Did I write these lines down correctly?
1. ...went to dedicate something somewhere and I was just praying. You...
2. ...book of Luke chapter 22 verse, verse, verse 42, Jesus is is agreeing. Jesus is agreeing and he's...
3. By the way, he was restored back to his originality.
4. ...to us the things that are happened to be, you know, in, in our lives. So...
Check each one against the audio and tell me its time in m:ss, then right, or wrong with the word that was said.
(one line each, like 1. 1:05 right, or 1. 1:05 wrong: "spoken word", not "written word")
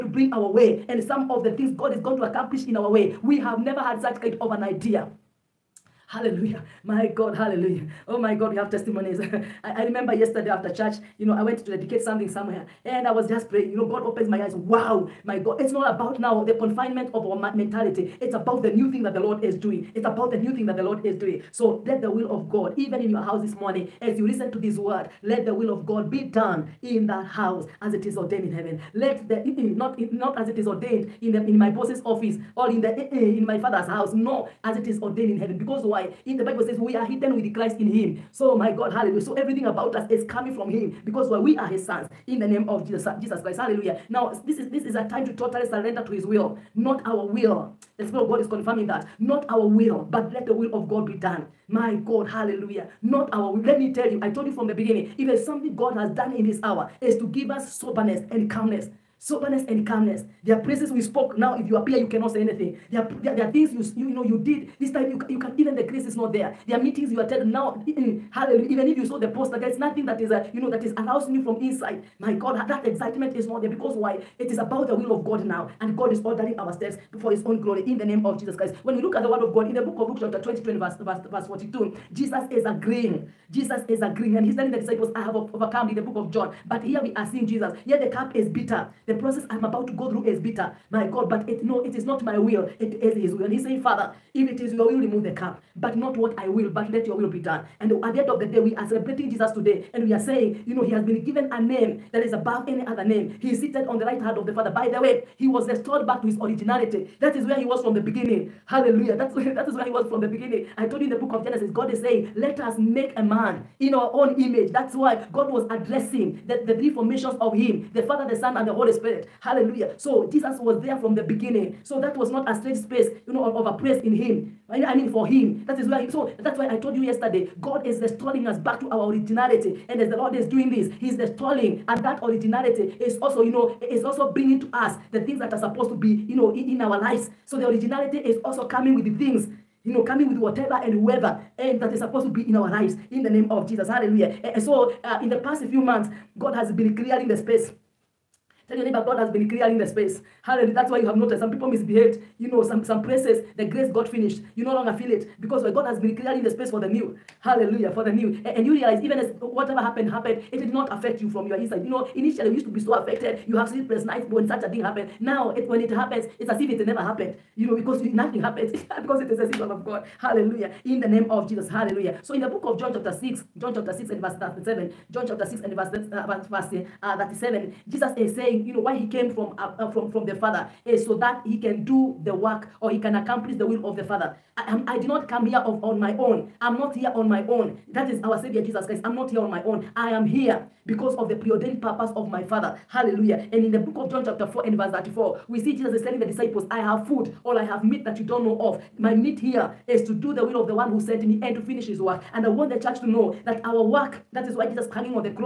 1. 0:11 right
2. 1:19 right
3. 1:44 right
4. 2:14 wrong: "supposed", not "happened".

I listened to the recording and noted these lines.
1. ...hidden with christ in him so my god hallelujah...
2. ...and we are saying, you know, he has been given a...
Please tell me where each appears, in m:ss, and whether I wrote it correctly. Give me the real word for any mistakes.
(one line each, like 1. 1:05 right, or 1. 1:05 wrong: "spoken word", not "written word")
1. 0:37 right
2. 1:39 right.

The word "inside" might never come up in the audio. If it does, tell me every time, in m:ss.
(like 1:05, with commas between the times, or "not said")
1:11, 2:41.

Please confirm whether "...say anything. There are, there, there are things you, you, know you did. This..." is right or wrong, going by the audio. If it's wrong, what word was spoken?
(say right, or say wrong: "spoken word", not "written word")
right.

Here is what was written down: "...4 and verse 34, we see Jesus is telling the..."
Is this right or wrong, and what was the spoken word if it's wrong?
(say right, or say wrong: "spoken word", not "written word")
right.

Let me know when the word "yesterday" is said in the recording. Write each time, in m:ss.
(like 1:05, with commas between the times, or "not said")
0:10, 2:07.